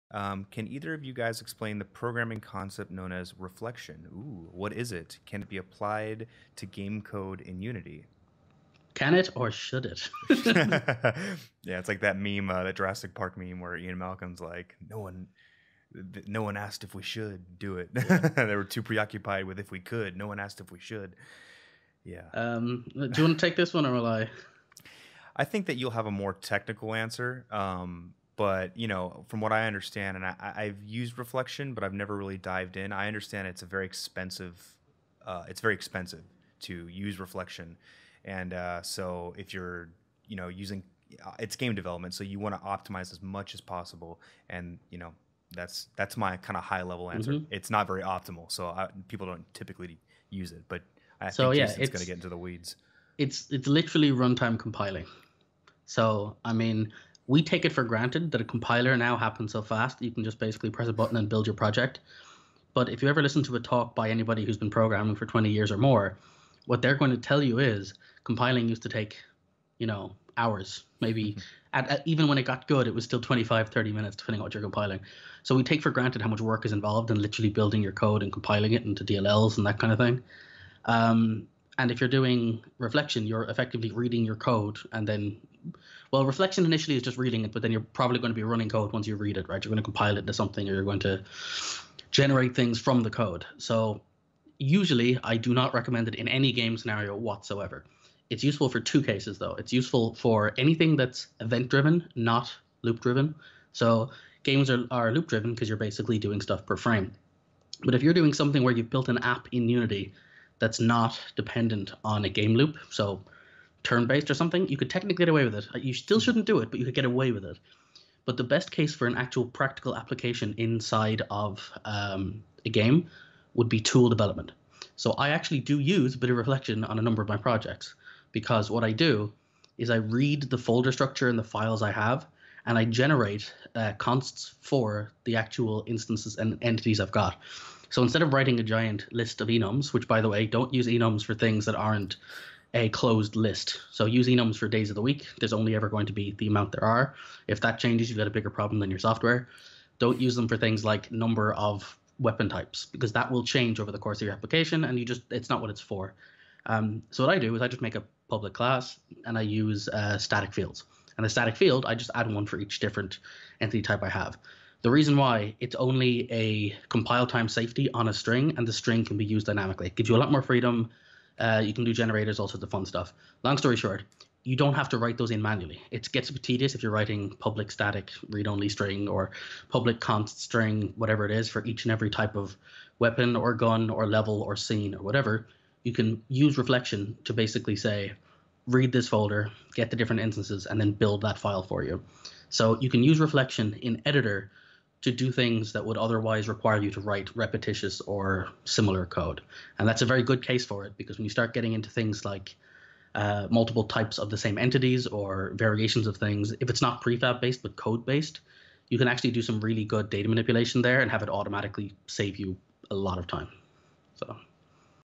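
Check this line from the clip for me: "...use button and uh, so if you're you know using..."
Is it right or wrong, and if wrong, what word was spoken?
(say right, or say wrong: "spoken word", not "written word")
wrong: "reflection", not "button".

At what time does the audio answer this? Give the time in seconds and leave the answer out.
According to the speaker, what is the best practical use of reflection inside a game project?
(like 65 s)
123 s.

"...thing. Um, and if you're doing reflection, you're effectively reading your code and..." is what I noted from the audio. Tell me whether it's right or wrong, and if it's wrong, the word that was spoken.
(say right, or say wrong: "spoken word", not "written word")
right.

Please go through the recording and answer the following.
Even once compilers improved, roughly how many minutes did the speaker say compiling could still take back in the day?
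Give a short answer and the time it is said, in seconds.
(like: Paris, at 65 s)
25, 30 minutes, at 73 s.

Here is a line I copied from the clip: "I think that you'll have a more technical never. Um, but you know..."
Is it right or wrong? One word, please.
wrong.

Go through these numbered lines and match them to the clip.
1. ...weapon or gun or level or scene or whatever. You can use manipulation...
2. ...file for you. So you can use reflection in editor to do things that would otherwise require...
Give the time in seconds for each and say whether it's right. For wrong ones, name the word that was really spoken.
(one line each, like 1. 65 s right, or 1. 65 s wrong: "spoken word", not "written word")
1. 182 s wrong: "reflection", not "manipulation"
2. 191 s right.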